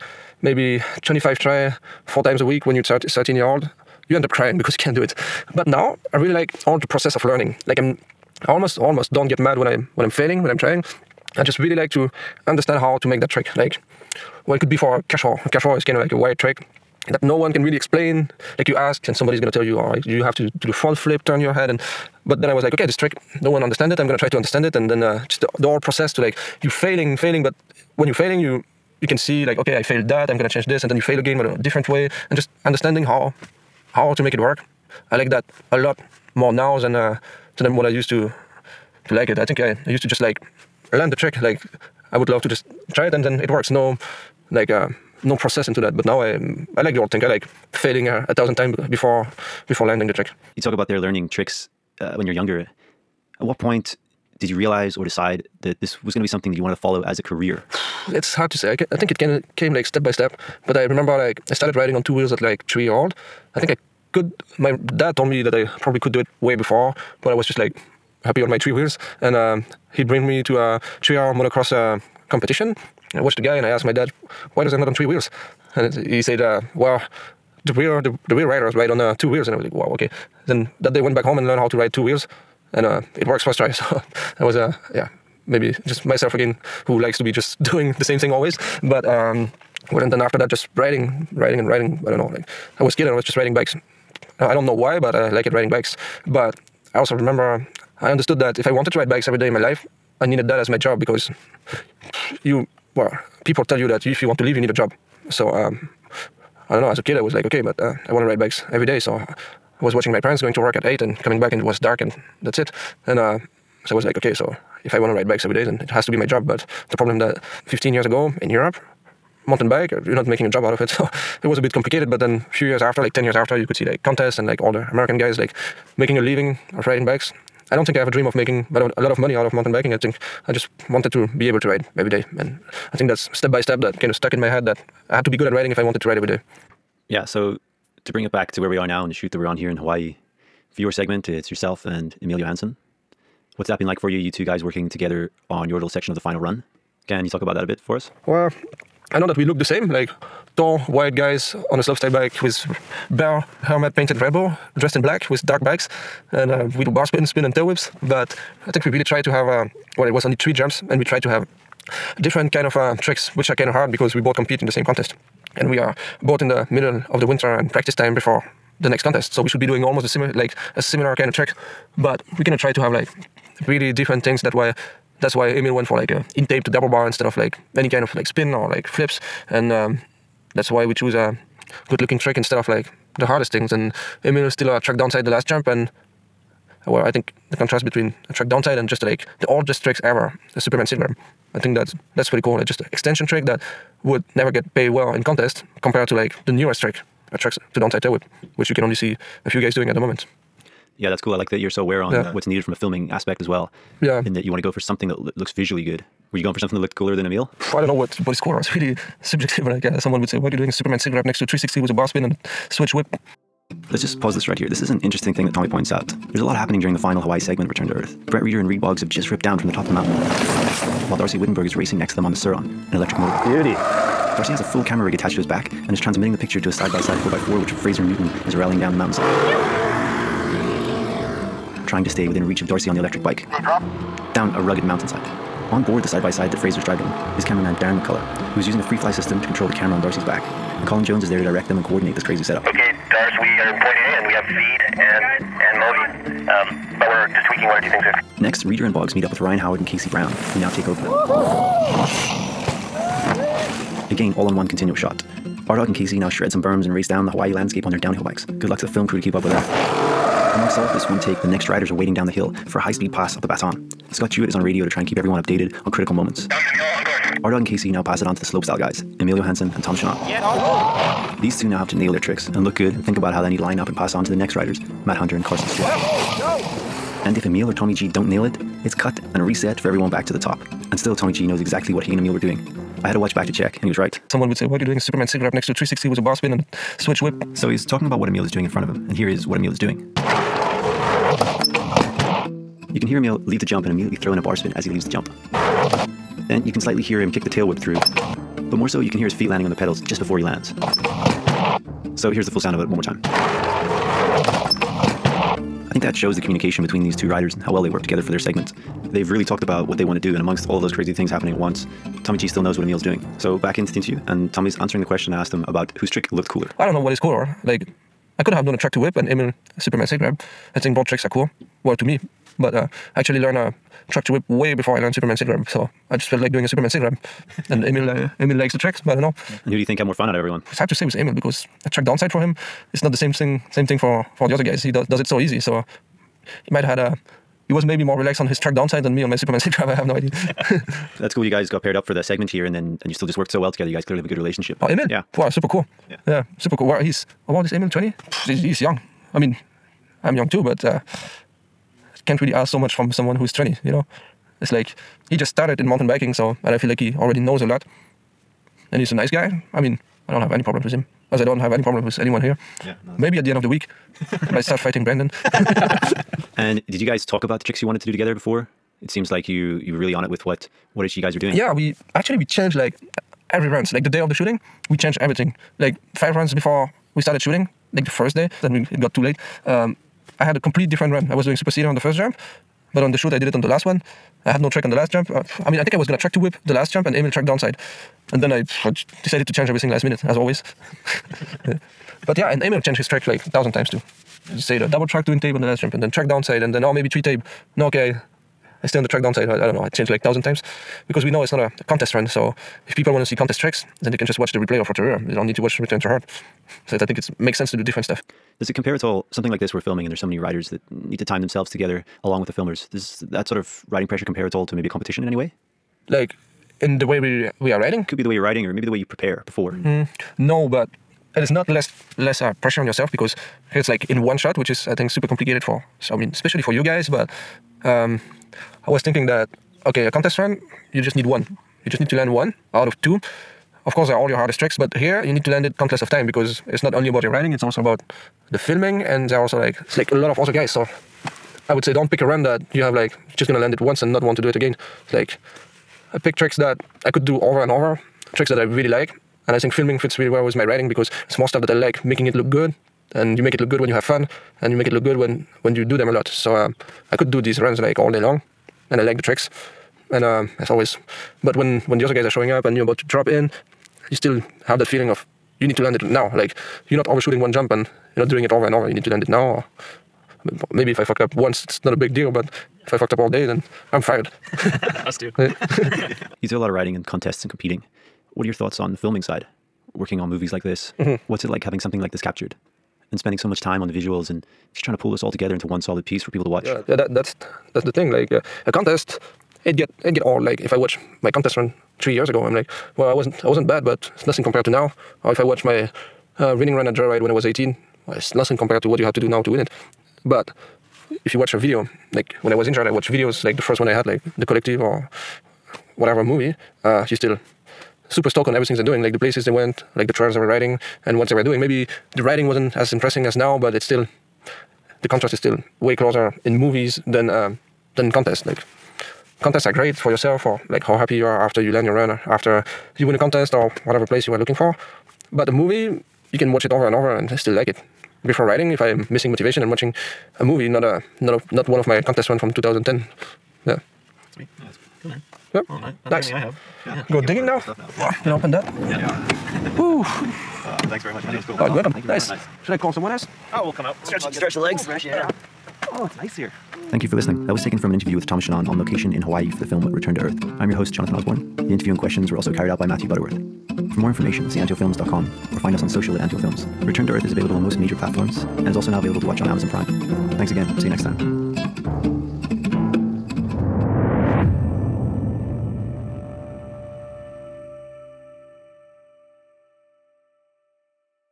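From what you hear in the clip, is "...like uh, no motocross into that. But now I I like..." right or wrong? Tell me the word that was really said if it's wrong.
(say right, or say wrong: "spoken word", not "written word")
wrong: "process", not "motocross".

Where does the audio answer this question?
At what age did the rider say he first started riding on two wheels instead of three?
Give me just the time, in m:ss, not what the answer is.
1:02.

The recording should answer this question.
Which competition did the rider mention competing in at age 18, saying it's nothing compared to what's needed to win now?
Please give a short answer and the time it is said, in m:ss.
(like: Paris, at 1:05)
Joyride, at 8:16.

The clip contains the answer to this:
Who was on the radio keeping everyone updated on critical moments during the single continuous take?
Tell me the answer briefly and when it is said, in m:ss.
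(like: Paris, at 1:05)
Scott Jewett, at 4:24.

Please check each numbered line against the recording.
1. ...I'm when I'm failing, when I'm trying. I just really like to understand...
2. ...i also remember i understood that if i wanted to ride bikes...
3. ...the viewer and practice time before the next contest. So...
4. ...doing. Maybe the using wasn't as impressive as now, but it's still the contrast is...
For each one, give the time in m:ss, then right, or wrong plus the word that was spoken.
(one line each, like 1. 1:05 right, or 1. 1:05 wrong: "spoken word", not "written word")
1. 0:09 right
2. 1:36 right
3. 2:47 wrong: "winter", not "viewer"
4. 8:31 wrong: "riding", not "using".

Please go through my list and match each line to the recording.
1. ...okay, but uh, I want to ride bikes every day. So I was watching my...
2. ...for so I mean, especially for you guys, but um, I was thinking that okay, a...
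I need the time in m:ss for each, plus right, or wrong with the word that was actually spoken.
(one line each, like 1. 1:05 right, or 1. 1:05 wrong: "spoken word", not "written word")
1. 1:47 right
2. 7:05 right.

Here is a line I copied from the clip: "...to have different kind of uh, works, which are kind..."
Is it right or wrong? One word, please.
wrong.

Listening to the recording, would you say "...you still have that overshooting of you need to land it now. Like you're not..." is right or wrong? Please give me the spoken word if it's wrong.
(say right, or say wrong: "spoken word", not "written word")
wrong: "feeling", not "overshooting".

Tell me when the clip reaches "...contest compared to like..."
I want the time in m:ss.
3:15.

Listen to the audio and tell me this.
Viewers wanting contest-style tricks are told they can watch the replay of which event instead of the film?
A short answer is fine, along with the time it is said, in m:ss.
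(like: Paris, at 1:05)
Rotorua, at 6:44.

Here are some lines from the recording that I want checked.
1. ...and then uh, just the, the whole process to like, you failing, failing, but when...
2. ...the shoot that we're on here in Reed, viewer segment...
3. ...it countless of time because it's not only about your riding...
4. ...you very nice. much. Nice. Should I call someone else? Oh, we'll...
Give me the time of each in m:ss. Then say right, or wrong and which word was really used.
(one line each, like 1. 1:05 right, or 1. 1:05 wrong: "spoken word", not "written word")
1. 0:24 right
2. 2:19 wrong: "Hawaii", not "Reed"
3. 7:15 right
4. 9:02 right.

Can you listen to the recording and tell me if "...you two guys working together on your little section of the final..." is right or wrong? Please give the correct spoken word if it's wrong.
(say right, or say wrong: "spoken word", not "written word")
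right.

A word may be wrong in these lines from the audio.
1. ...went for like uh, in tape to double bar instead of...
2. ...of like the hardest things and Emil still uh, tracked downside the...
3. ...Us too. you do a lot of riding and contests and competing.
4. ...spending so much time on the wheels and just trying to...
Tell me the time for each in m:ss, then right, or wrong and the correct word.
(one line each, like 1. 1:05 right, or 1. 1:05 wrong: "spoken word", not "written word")
1. 2:55 right
2. 3:02 right
3. 7:55 right
4. 8:03 wrong: "visuals", not "wheels".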